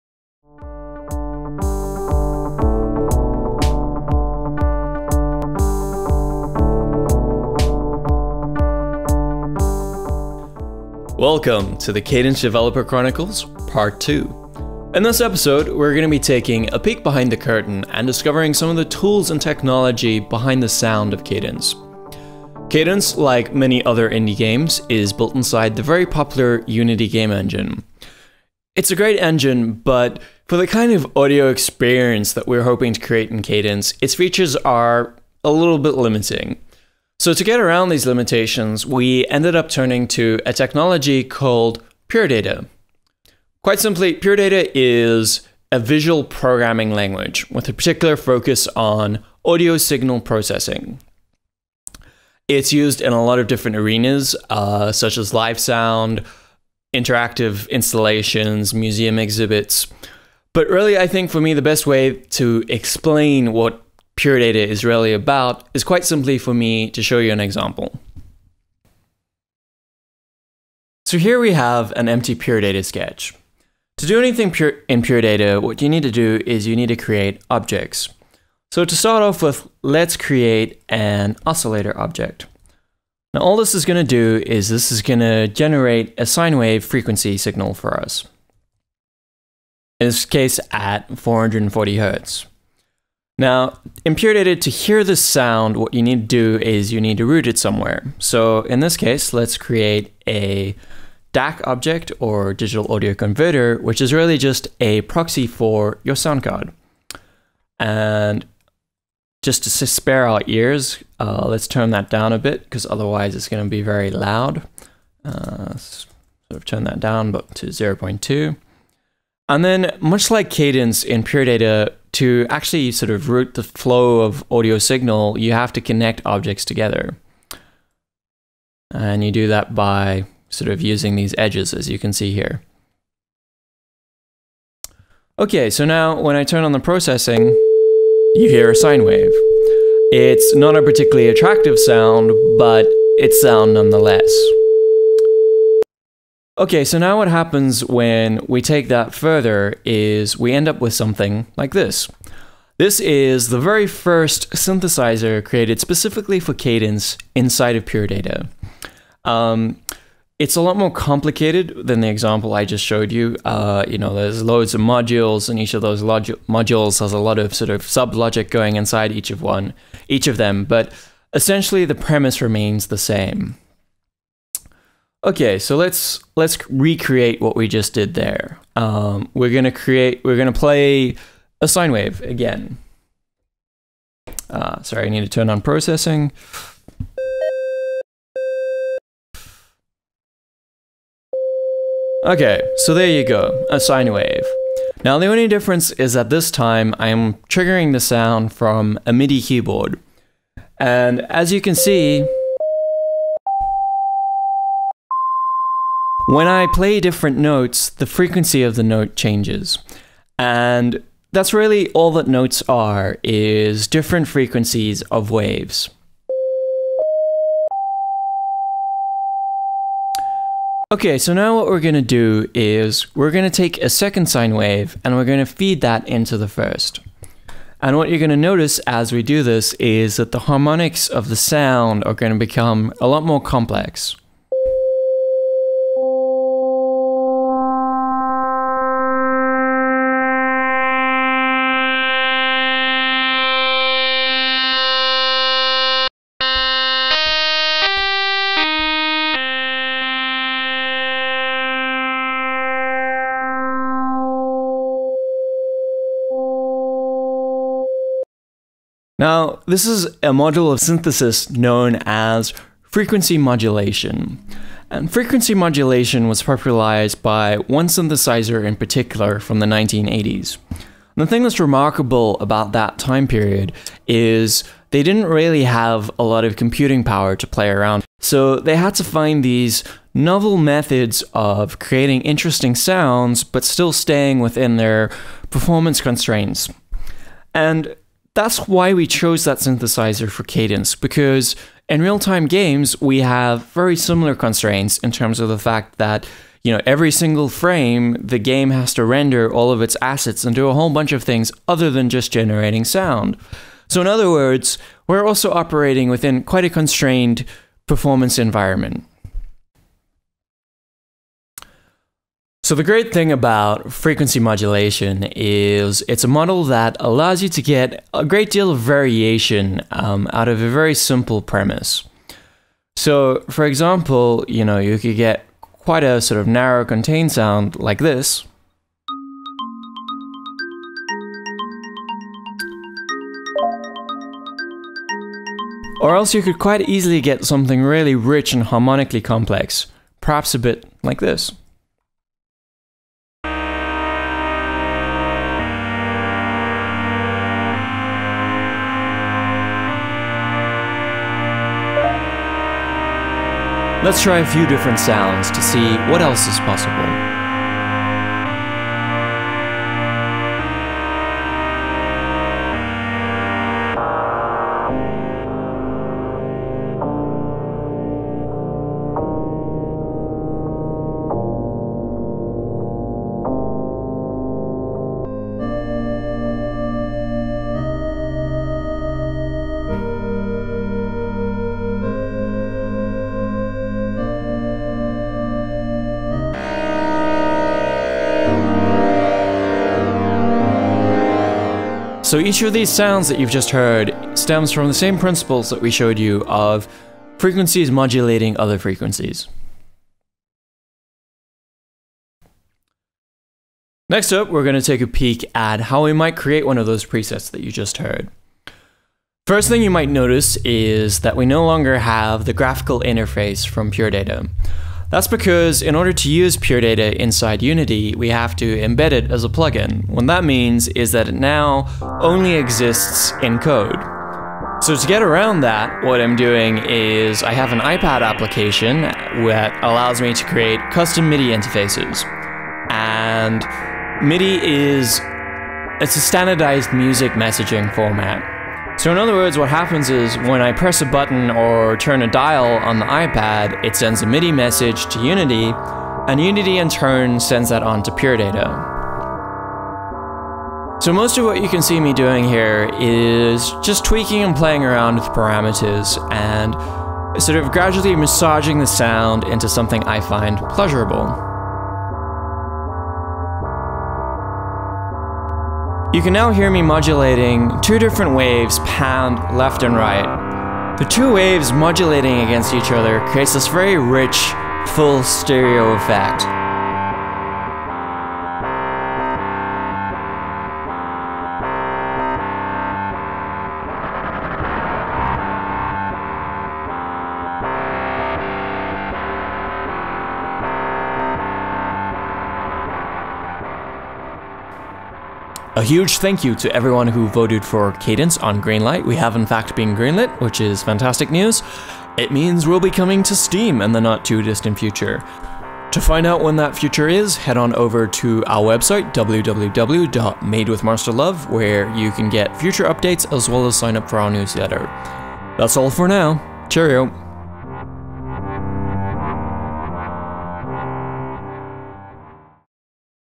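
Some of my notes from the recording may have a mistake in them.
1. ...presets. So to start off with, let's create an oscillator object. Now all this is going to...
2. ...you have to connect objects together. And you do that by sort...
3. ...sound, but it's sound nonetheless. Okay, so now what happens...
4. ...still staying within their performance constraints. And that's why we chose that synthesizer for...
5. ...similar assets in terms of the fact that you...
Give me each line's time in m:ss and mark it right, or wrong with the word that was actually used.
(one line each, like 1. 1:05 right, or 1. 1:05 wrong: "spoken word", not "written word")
1. 1:17 wrong: "objects", not "presets"
2. 2:05 right
3. 2:21 right
4. 4:43 right
5. 4:53 wrong: "constraints", not "assets".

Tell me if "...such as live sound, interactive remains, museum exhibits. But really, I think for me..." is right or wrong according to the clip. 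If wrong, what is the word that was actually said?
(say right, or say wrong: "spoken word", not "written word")
wrong: "installations", not "remains".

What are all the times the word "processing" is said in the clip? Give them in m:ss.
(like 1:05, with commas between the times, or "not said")
0:50, 2:16, 3:05.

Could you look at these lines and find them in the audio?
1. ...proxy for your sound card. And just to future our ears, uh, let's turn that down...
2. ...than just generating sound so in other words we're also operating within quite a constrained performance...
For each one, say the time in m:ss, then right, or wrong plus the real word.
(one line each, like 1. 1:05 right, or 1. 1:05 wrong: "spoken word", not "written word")
1. 1:45 wrong: "spare", not "future"
2. 5:01 right.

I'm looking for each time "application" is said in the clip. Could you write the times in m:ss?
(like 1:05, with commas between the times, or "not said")
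7:08.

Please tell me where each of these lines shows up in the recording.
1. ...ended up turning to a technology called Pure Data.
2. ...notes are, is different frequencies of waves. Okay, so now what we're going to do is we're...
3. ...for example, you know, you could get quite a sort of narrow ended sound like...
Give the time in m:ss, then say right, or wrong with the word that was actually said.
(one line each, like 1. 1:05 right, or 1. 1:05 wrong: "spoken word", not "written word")
1. 0:39 right
2. 3:32 right
3. 5:23 wrong: "contained", not "ended".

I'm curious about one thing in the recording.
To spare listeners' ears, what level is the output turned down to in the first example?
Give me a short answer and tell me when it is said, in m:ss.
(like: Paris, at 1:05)
0.2, at 1:57.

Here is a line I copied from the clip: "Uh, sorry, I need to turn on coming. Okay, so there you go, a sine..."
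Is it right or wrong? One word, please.
wrong.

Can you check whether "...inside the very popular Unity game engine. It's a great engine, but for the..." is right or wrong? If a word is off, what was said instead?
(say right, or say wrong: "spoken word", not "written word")
right.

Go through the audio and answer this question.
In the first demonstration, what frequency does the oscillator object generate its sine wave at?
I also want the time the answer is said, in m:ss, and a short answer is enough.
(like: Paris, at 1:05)
440 hertz, at 1:31.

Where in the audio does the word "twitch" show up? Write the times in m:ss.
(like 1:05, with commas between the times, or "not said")
not said.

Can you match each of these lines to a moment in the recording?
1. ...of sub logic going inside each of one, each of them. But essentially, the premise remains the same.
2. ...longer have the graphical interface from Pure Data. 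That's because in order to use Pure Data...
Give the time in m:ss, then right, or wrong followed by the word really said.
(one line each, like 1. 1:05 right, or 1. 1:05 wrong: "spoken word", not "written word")
1. 2:47 right
2. 6:51 right.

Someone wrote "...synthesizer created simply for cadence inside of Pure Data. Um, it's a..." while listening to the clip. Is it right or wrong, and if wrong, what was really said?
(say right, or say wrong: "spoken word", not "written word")
wrong: "specifically", not "simply".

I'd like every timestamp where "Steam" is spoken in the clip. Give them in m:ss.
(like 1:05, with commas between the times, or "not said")
8:23.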